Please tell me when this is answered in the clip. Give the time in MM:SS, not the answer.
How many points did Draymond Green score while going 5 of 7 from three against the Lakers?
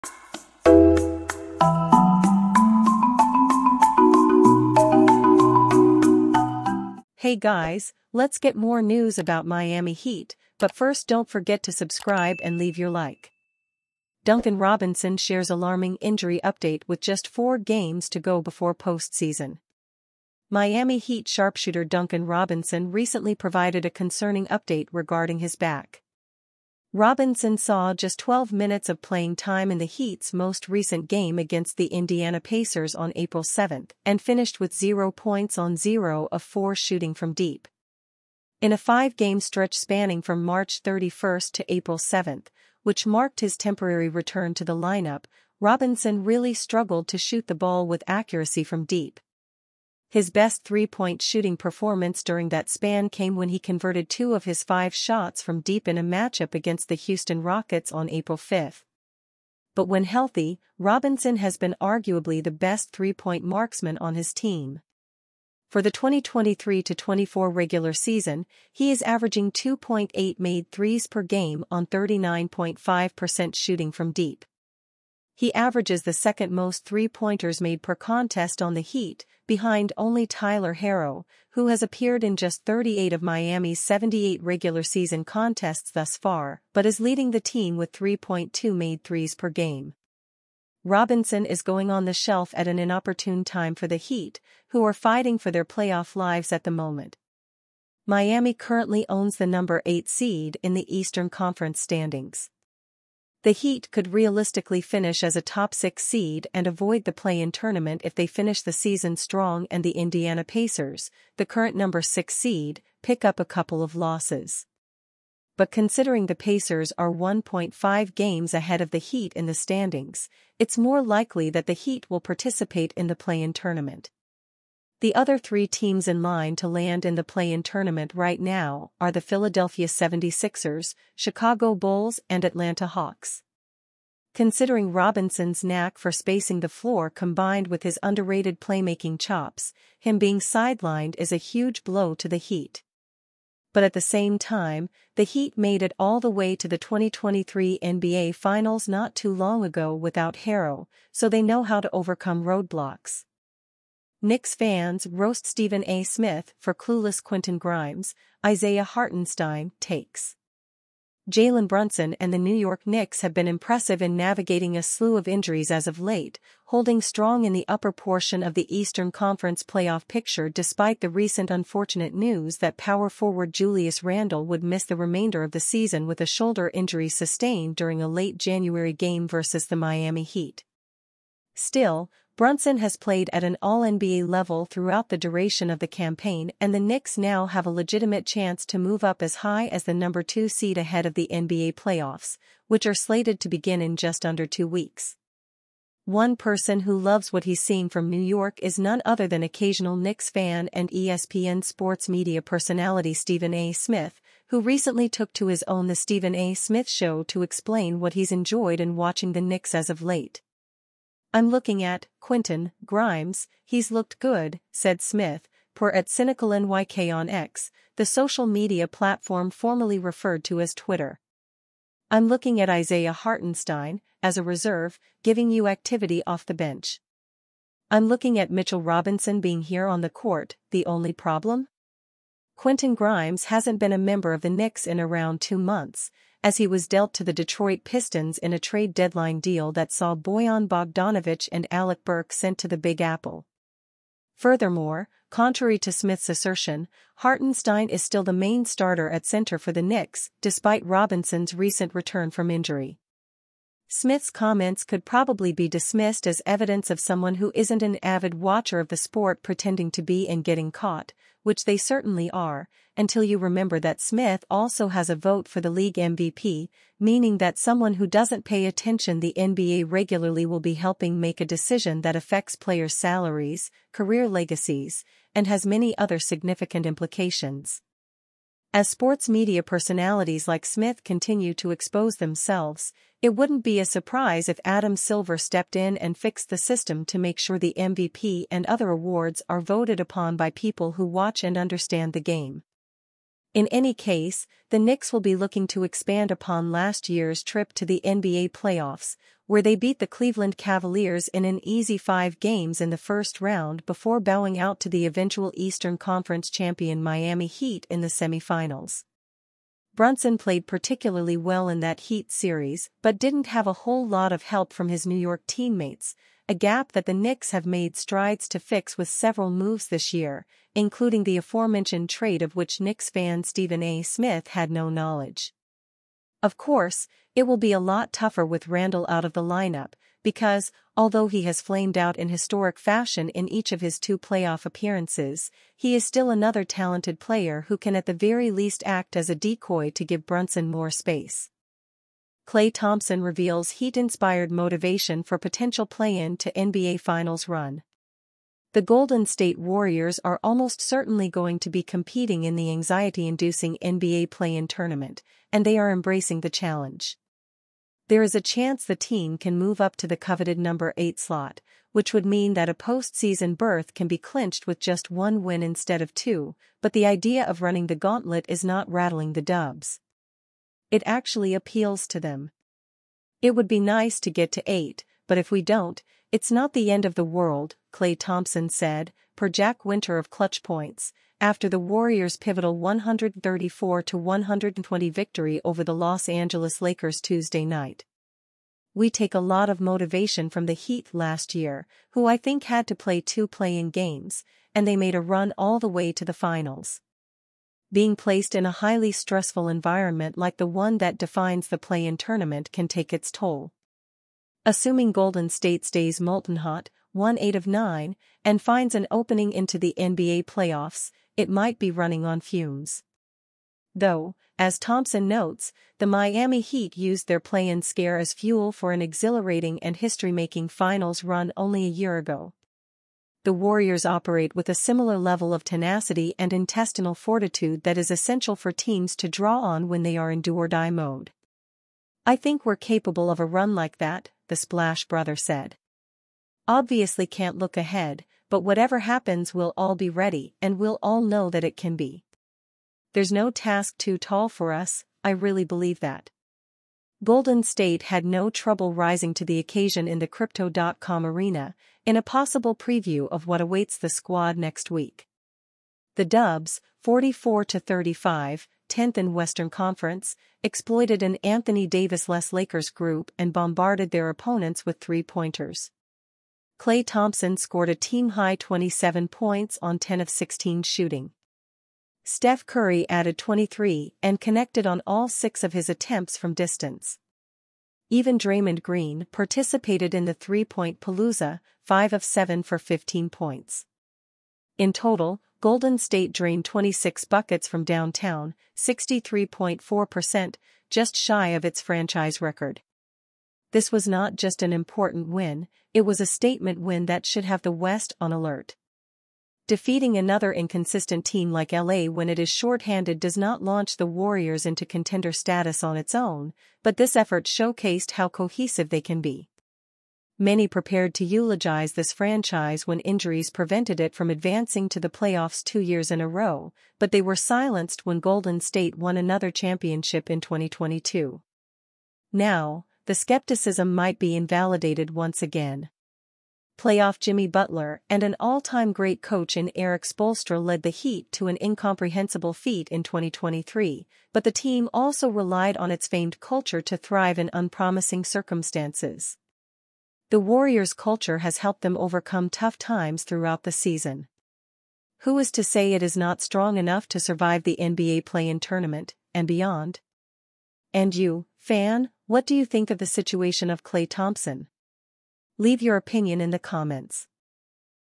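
08:02.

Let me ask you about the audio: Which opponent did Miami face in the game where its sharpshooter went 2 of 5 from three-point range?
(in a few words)
Houston Rockets.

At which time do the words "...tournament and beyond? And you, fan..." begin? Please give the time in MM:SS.
09:08.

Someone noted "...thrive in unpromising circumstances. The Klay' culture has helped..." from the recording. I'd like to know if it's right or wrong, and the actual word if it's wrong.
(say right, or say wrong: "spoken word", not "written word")
wrong: "Warriors", not "Klay".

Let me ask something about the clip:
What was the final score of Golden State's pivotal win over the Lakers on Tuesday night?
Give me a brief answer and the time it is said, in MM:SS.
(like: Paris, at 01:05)
134-120, at 06:22.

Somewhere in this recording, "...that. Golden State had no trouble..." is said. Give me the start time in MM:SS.
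07:26.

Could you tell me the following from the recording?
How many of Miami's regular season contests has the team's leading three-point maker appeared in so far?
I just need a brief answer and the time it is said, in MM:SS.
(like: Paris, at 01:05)
38, at 01:22.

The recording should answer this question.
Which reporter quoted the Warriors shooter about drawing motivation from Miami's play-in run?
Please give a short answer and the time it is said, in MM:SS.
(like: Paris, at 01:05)
Jack Winter, at 06:19.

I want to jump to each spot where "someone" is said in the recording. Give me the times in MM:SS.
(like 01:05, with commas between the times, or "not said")
04:16, 04:27.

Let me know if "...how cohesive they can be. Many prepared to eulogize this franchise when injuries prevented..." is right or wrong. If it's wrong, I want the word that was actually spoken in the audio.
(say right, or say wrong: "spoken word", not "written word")
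right.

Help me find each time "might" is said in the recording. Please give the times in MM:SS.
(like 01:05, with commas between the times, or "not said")
06:51, 08:43.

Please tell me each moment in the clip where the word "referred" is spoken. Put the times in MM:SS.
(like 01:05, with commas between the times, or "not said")
03:39.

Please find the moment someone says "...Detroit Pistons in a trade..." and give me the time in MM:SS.
03:57.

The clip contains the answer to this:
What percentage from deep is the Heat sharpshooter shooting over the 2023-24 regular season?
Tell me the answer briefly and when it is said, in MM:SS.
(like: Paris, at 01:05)
39.5%, at 01:11.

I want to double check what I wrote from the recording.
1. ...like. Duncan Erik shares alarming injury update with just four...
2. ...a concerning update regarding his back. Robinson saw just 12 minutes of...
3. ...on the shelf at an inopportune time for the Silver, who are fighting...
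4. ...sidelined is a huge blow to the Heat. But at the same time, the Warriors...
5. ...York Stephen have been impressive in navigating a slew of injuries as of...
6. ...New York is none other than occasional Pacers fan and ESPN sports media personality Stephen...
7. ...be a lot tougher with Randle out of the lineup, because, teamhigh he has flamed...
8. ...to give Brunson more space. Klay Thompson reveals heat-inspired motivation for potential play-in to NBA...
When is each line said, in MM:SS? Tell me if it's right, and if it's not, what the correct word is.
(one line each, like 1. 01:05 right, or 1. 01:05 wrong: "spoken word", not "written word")
1. 00:12 wrong: "Robinson", not "Erik"
2. 00:23 right
3. 01:31 wrong: "Heat", not "Silver"
4. 02:20 wrong: "Heat", not "Warriors"
5. 02:42 wrong: "Knicks", not "Stephen"
6. 03:18 wrong: "Knicks", not "Pacers"
7. 05:27 wrong: "although", not "teamhigh"
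8. 05:39 right.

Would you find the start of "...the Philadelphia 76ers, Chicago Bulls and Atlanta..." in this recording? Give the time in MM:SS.
02:09.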